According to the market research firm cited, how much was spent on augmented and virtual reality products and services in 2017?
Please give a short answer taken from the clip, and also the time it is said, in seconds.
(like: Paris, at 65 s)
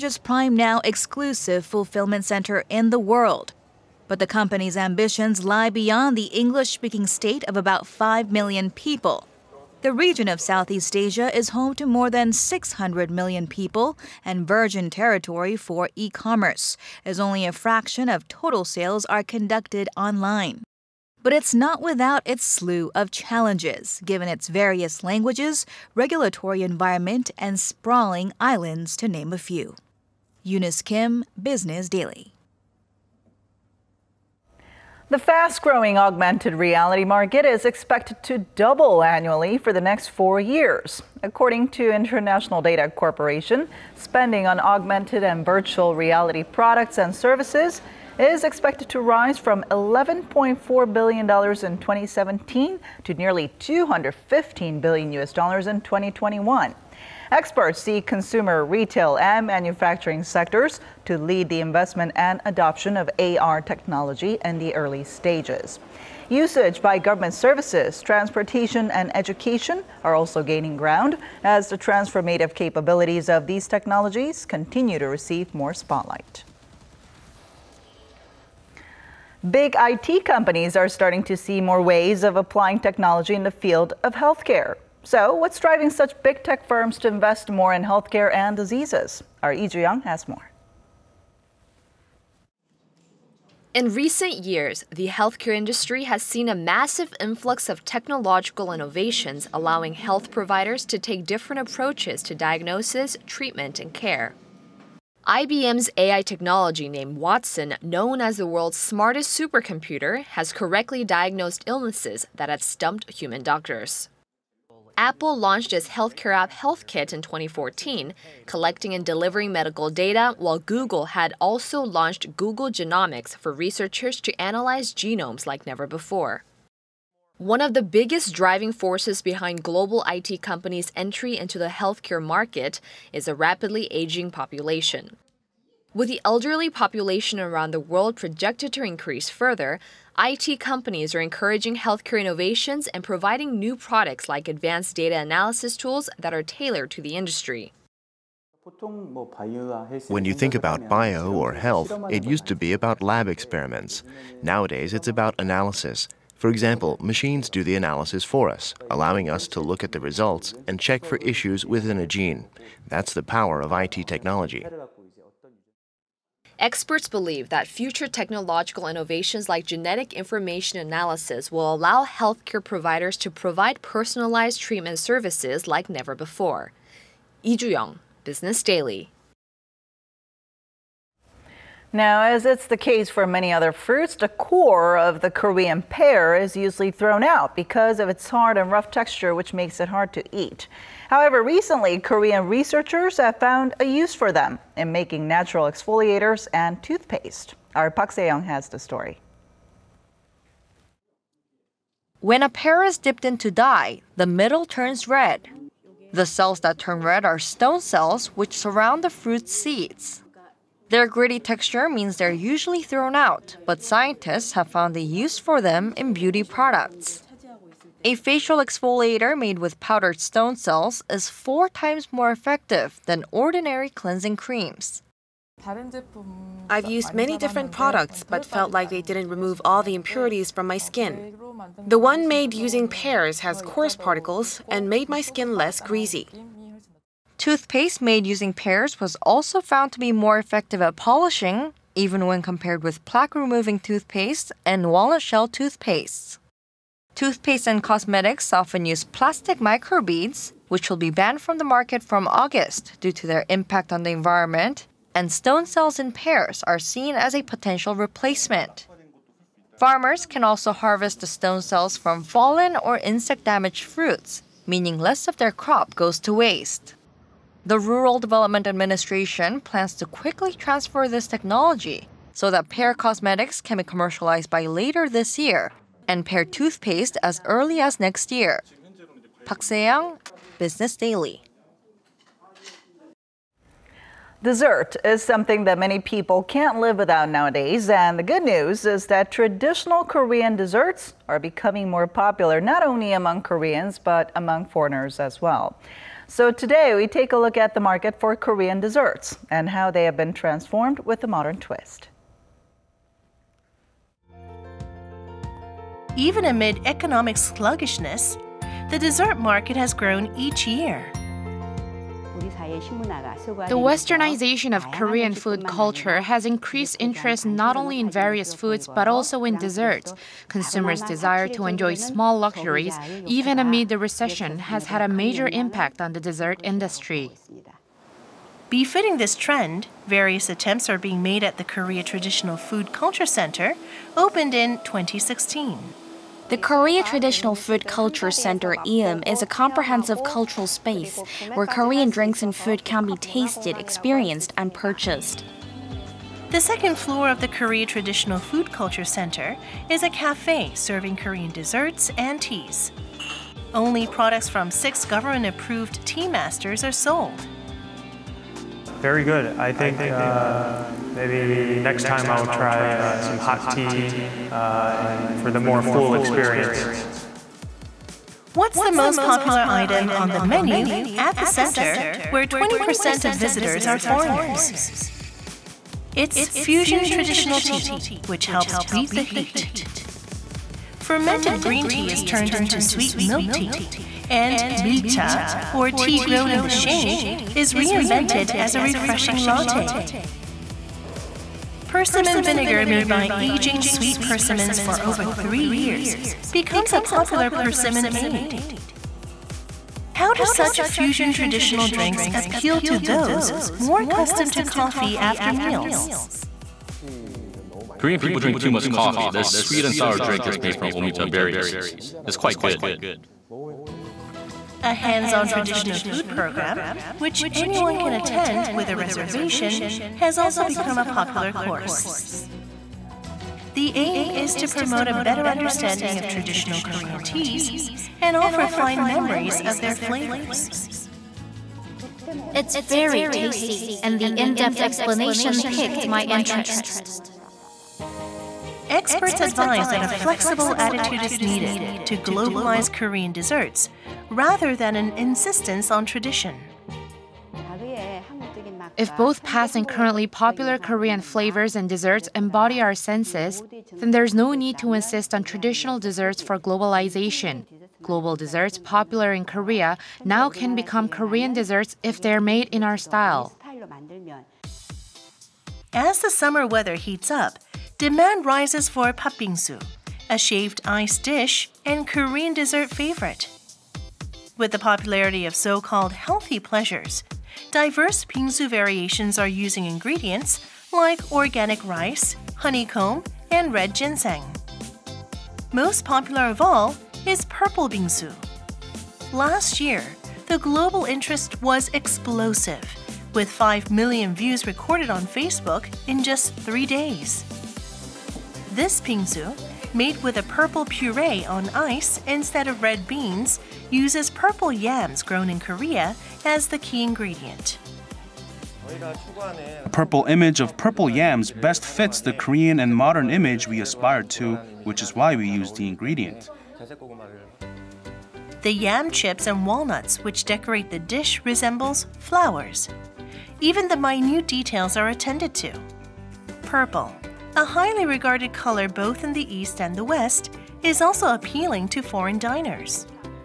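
$11.4 billion, at 49 s.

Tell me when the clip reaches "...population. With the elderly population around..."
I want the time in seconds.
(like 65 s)
134 s.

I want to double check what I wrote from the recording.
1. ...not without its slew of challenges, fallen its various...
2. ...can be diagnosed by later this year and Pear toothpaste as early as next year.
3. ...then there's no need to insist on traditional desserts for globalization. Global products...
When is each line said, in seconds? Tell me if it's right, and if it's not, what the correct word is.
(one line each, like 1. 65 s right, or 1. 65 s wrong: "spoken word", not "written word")
1. 21 s wrong: "given", not "fallen"
2. 273 s wrong: "commercialized", not "diagnosed"
3. 453 s wrong: "desserts", not "products".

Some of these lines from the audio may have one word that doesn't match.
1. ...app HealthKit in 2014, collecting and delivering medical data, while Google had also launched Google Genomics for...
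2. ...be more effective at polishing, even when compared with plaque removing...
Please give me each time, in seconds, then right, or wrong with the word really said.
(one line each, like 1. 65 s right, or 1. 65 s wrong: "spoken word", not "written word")
1. 116 s right
2. 240 s right.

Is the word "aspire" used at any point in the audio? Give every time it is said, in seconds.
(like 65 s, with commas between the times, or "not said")
513 s.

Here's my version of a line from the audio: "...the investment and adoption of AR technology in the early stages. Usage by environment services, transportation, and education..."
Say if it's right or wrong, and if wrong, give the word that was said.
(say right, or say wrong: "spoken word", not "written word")
wrong: "government", not "environment".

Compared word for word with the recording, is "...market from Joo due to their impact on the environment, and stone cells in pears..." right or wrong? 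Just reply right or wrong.
wrong.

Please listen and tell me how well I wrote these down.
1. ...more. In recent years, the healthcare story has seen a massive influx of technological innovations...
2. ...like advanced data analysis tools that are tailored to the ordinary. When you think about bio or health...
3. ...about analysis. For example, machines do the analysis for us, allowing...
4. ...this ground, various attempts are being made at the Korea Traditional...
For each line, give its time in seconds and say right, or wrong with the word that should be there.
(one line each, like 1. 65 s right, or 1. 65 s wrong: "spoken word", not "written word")
1. 90 s wrong: "industry", not "story"
2. 144 s wrong: "industry", not "ordinary"
3. 155 s right
4. 329 s wrong: "trend", not "ground".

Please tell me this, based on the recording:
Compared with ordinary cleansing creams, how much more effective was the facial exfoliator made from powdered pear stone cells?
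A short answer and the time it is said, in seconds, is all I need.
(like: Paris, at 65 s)
four times, at 221 s.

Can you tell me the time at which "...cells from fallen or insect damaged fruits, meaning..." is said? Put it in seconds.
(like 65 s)
261 s.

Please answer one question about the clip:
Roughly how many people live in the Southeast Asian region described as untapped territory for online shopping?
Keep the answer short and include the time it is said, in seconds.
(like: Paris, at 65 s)
more than 600 million, at 11 s.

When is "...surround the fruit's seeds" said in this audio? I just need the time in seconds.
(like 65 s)
208 s.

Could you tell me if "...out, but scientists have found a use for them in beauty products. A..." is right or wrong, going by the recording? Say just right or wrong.
right.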